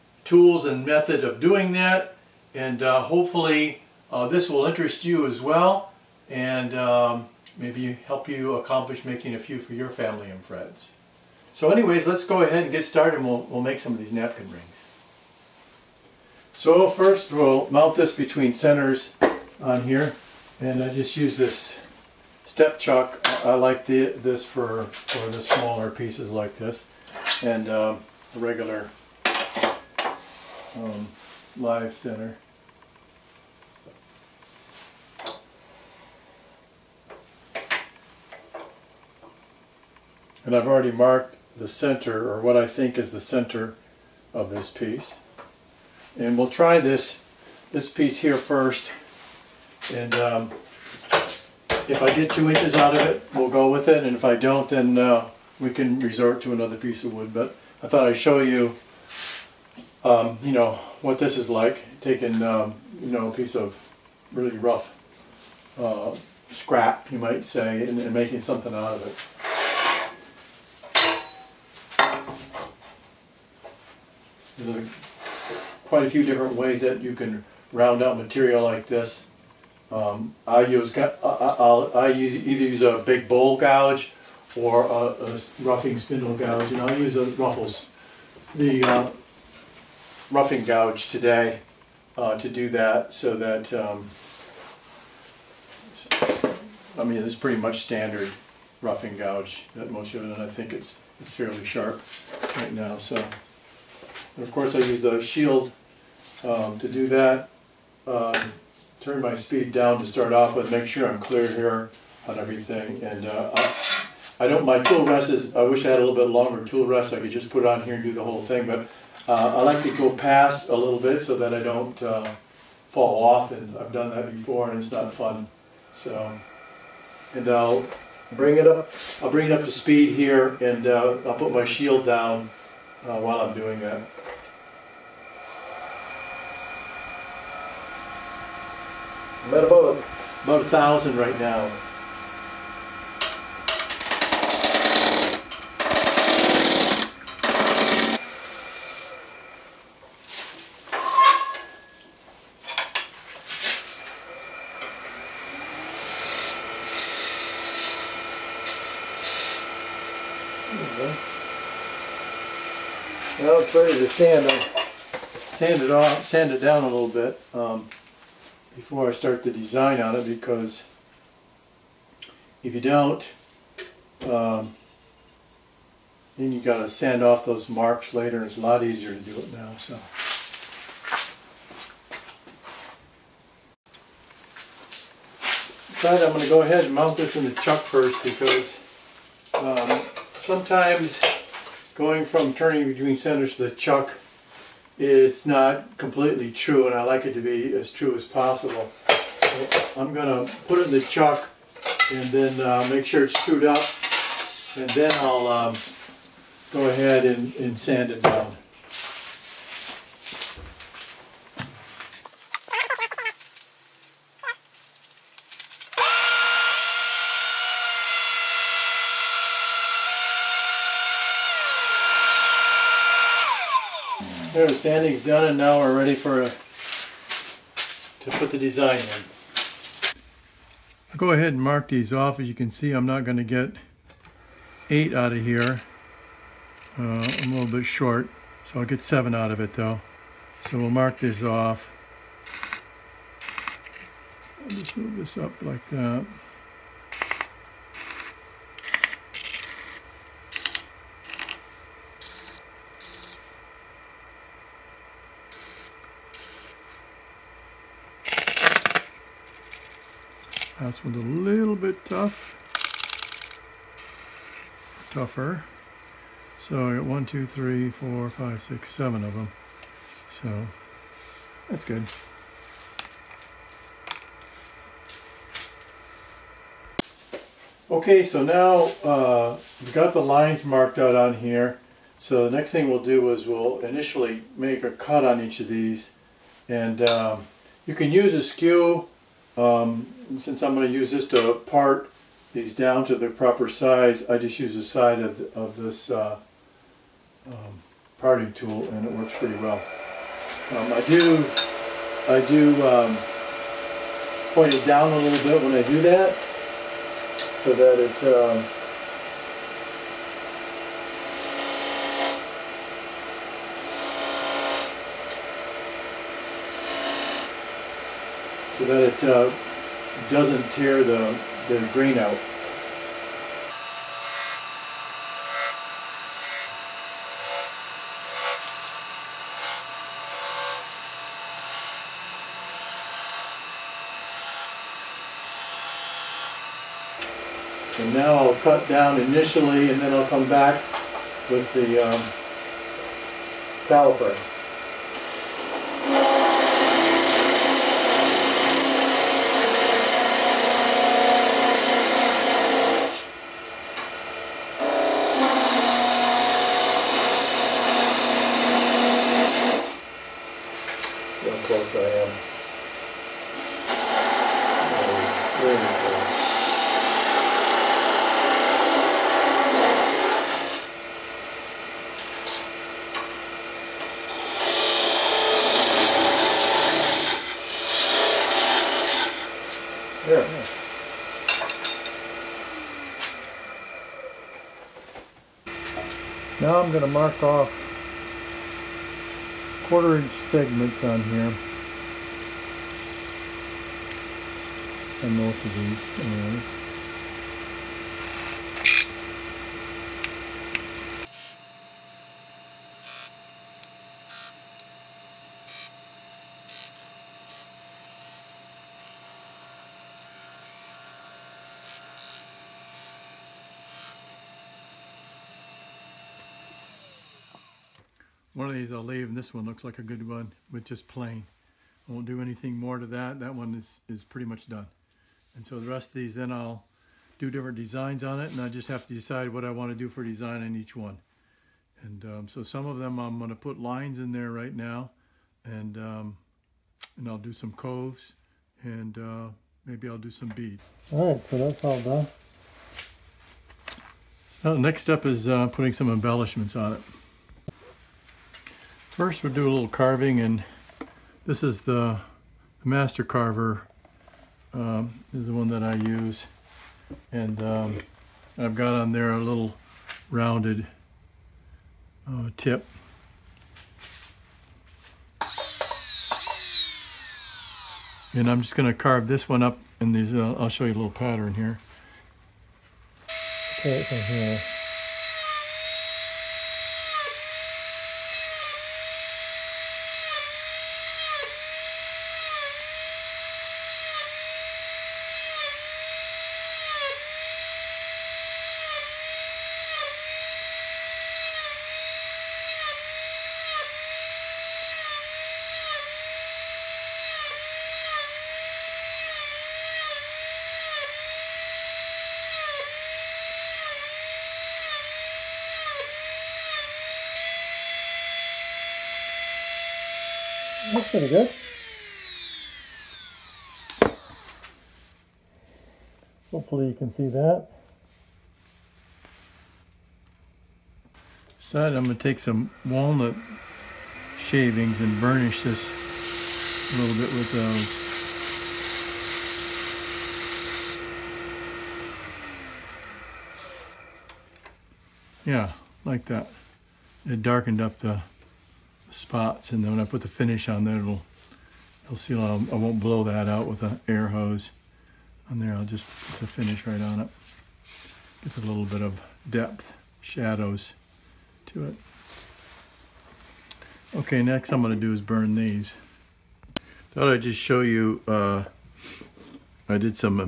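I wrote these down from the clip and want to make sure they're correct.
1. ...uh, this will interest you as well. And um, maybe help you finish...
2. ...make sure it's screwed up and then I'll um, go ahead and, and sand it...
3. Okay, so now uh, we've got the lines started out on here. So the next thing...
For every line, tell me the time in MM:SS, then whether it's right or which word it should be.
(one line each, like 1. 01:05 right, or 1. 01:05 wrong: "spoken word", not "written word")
1. 00:04 wrong: "accomplish", not "finish"
2. 03:22 right
3. 04:37 wrong: "marked", not "started".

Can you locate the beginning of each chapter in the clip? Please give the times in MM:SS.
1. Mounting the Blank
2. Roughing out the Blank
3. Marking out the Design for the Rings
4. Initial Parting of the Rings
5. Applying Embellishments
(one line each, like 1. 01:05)
1. 00:15
2. 01:13
3. 03:46
4. 04:40
5. 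07:23.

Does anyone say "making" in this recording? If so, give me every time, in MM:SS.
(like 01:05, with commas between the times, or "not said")
00:09, 01:08.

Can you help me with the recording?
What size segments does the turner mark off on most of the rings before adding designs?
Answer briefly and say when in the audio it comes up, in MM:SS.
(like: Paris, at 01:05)
quarter inch, at 06:29.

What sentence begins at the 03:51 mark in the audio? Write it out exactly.
I'll go ahead and mark these off.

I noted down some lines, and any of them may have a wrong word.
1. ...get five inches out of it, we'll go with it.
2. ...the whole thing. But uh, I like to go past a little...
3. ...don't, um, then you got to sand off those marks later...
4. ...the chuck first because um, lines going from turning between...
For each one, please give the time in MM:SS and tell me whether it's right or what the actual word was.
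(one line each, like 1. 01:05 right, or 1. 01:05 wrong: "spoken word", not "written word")
1. 00:52 wrong: "two", not "five"
2. 01:58 right
3. 02:52 right
4. 03:07 wrong: "sometimes", not "lines".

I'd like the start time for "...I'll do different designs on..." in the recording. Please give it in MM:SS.
07:06.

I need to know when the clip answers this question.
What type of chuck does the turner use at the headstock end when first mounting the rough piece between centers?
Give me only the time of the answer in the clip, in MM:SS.
00:22.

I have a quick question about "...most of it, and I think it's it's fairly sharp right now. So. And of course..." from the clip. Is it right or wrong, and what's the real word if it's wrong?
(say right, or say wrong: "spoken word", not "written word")
right.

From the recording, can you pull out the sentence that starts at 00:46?
And we'll try this, this piece here first.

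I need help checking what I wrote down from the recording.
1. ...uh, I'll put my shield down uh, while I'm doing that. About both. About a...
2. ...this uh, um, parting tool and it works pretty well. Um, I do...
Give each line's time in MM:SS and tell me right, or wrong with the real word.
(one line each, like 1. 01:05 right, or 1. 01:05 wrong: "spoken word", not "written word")
1. 02:10 right
2. 04:55 right.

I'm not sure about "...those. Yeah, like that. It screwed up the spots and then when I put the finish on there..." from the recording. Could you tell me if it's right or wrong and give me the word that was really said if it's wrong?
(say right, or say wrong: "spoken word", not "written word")
wrong: "darkened", not "screwed".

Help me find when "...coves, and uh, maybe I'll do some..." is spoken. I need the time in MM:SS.
07:17.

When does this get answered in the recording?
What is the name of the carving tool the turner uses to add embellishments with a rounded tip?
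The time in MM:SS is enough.
07:32.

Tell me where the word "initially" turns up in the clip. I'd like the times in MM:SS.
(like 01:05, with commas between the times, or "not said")
04:43, 05:39.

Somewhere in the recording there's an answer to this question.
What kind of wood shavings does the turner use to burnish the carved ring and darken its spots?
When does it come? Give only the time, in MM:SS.
08:42.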